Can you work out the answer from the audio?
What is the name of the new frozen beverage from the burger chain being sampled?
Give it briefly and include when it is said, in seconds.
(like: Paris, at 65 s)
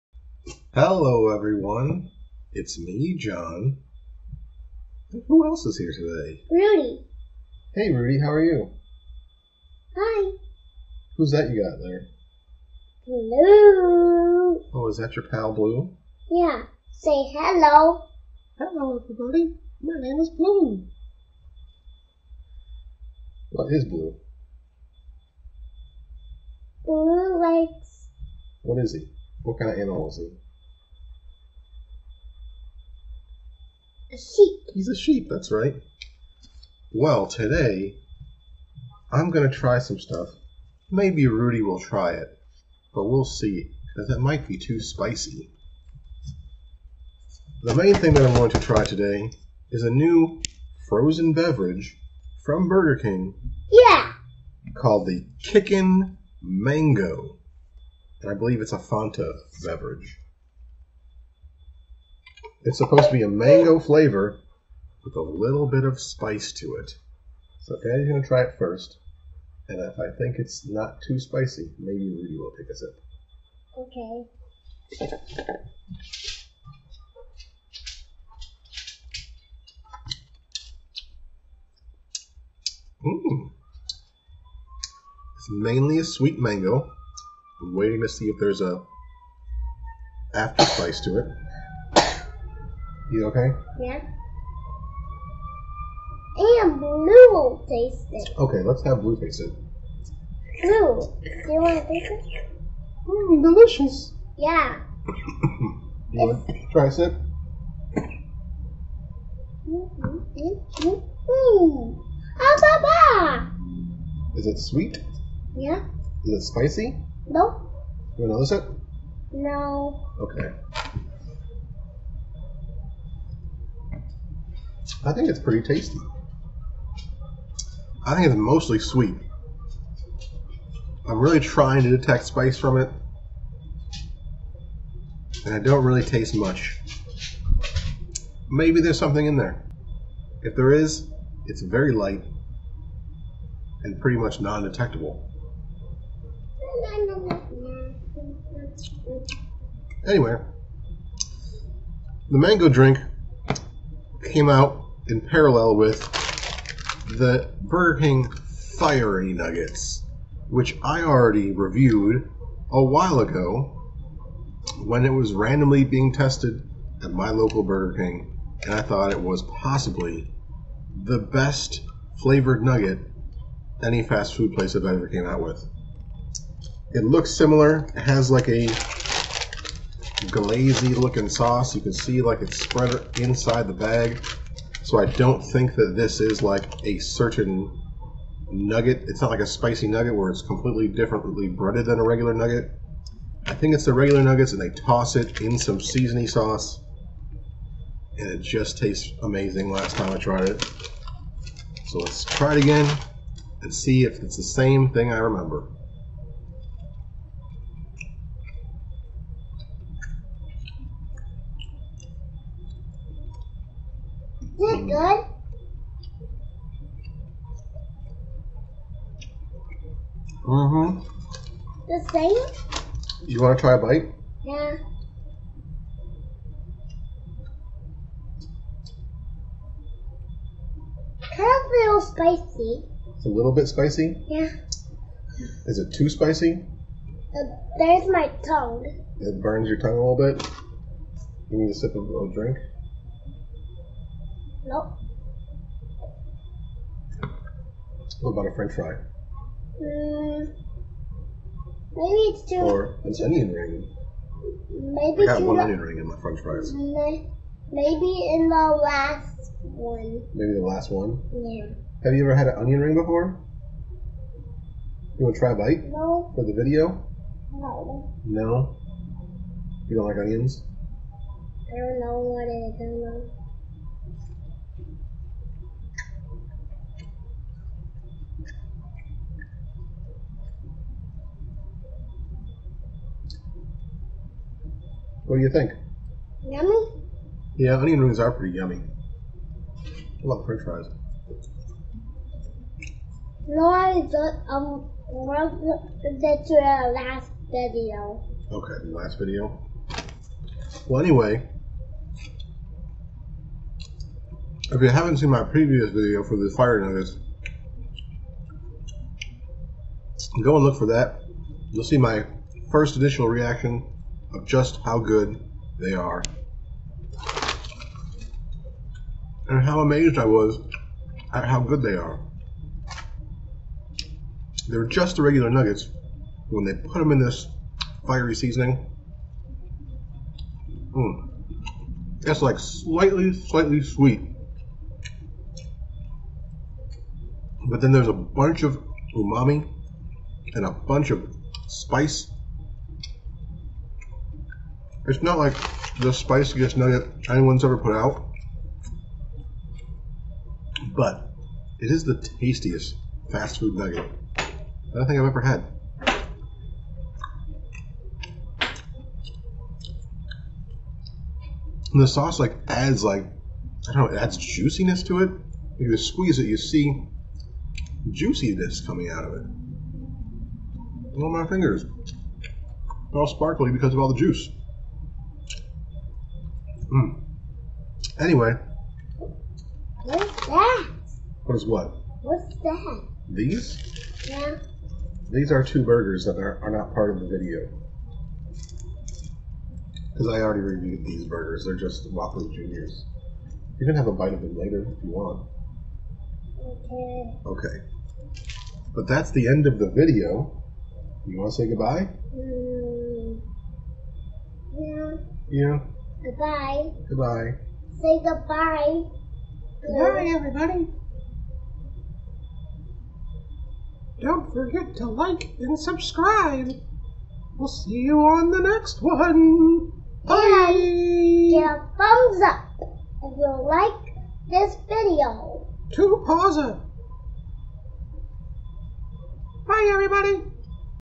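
Kickin' Mango, at 55 s.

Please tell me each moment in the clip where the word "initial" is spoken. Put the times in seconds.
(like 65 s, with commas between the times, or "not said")
312 s.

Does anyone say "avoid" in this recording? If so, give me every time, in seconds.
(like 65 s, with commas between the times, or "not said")
not said.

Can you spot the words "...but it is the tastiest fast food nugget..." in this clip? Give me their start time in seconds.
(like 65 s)
350 s.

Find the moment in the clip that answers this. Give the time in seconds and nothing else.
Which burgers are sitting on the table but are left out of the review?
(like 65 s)
392 s.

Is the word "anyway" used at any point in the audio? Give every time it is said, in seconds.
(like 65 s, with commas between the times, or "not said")
150 s, 301 s, 378 s.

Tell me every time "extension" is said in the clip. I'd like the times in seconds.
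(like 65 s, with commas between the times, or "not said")
not said.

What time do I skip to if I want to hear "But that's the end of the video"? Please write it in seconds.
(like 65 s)
398 s.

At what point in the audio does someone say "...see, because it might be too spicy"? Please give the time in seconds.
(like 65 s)
43 s.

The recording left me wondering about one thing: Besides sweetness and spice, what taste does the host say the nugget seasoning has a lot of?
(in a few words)
Umami.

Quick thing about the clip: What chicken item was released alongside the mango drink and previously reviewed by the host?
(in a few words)
Fiery Nuggets.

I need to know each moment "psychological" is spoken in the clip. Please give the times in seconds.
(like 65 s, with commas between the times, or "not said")
not said.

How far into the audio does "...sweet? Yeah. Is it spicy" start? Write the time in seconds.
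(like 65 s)
114 s.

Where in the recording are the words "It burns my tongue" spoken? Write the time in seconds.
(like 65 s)
237 s.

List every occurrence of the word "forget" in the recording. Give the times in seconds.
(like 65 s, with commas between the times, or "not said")
414 s.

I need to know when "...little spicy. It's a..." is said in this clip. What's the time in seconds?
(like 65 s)
231 s.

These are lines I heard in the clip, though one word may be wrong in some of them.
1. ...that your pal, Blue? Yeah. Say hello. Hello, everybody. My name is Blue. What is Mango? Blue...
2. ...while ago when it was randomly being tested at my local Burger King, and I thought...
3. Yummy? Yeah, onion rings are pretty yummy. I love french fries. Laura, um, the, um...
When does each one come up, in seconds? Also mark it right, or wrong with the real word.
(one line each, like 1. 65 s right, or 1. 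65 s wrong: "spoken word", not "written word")
1. 14 s wrong: "Blue", not "Mango"
2. 162 s right
3. 286 s right.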